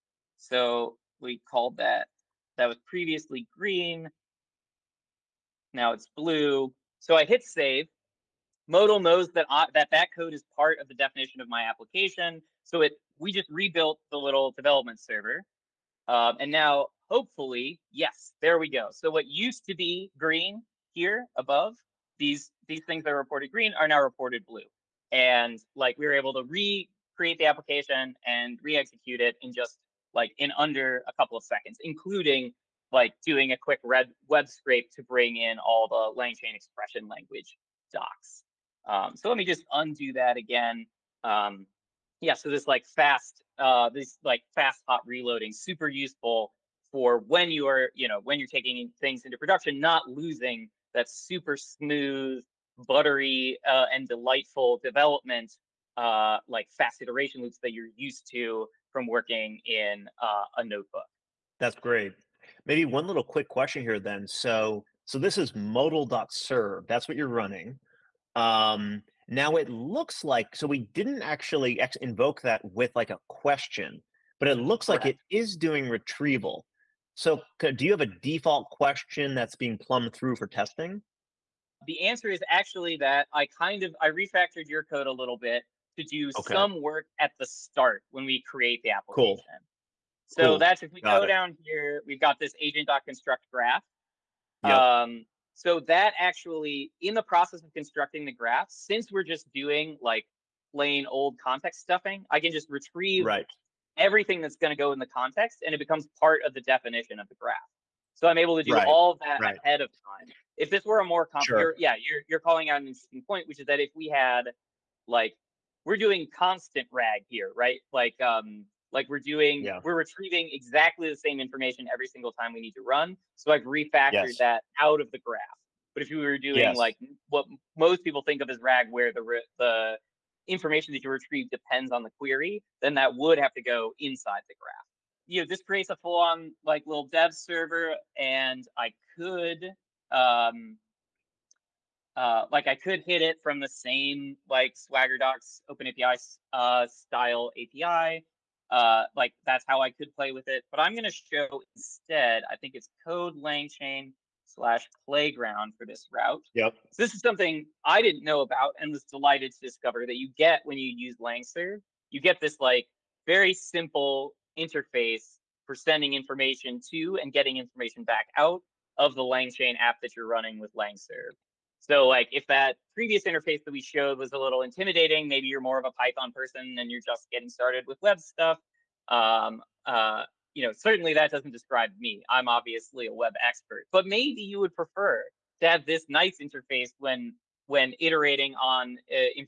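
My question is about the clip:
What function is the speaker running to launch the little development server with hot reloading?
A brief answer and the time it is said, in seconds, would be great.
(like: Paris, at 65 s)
modal.serve, at 65 s.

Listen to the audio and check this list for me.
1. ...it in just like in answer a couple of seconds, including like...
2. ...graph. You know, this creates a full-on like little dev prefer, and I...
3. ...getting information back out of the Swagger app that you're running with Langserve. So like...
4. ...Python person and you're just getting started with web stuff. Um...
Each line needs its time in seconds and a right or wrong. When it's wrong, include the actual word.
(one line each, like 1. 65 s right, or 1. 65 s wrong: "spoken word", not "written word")
1. 29 s wrong: "under", not "answer"
2. 134 s wrong: "server", not "prefer"
3. 167 s wrong: "LangChain", not "Swagger"
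4. 175 s right.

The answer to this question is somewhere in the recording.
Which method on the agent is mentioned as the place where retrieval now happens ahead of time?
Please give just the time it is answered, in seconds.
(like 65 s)
92 s.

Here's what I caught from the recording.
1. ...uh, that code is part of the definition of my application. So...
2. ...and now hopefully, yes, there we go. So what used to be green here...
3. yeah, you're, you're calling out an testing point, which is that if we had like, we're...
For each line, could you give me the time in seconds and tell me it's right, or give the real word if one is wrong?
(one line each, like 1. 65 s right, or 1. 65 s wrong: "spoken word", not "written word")
1. 9 s right
2. 16 s right
3. 111 s wrong: "interesting", not "testing".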